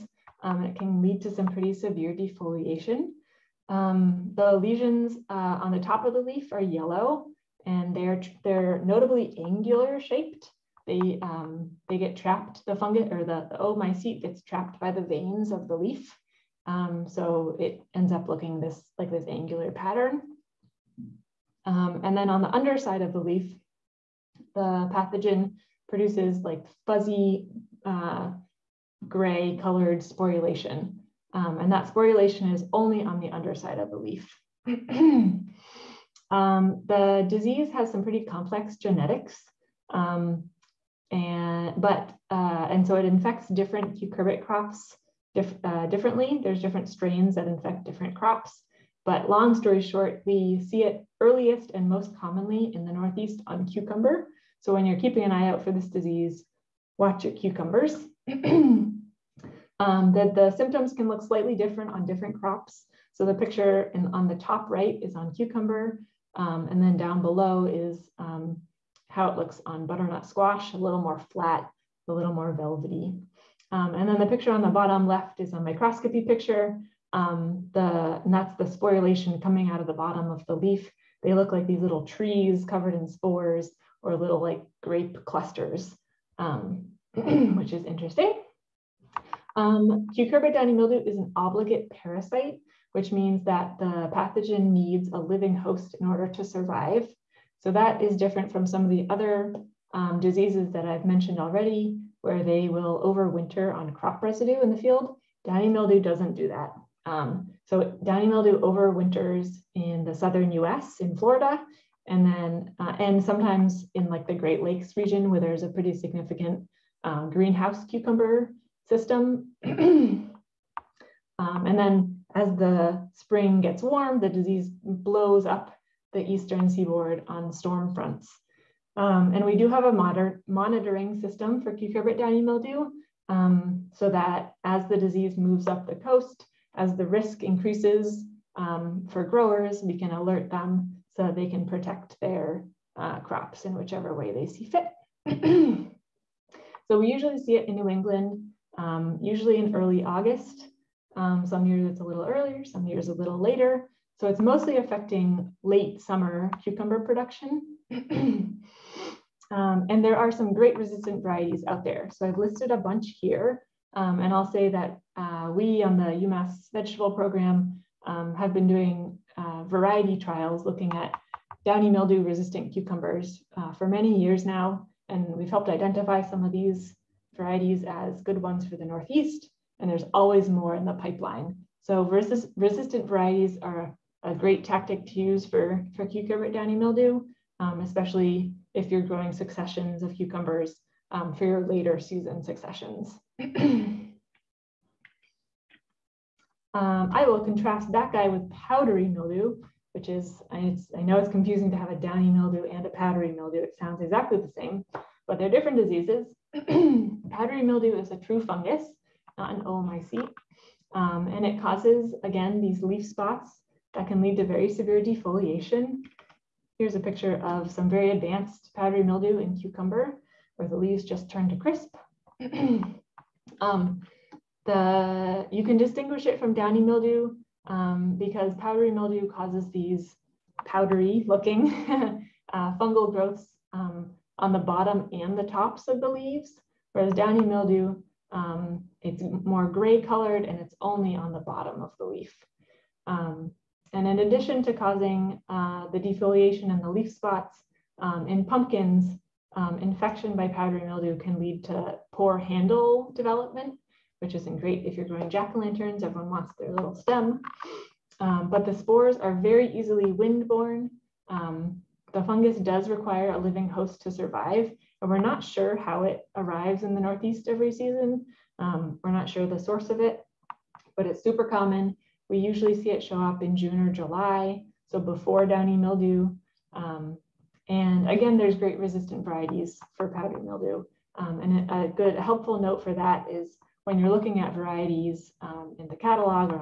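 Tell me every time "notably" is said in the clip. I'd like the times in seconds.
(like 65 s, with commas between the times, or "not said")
8 s.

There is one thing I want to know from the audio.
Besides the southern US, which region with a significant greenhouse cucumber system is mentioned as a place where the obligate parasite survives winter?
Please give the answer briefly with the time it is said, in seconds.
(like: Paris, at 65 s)
Great Lakes region, at 114 s.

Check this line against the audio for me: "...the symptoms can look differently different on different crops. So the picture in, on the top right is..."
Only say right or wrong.
wrong.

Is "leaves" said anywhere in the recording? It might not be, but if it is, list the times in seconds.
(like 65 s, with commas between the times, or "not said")
220 s, 236 s.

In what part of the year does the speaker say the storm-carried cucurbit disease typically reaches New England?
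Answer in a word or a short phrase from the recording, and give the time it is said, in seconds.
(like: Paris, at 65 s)
Early August, at 149 s.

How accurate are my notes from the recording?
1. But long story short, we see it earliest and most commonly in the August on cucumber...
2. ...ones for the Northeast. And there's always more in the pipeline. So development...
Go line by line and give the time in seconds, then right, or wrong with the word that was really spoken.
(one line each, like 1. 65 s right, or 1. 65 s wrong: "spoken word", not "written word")
1. 49 s wrong: "Northeast", not "August"
2. 178 s wrong: "resistant", not "development".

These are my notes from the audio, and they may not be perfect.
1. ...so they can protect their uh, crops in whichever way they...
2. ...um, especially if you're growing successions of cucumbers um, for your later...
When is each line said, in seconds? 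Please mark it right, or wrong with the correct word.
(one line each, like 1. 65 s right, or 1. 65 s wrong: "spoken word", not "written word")
1. 141 s right
2. 187 s right.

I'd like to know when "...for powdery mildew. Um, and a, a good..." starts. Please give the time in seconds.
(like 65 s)
279 s.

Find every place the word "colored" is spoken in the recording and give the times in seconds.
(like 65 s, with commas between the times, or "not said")
29 s, 240 s.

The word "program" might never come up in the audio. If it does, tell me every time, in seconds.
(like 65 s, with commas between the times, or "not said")
167 s.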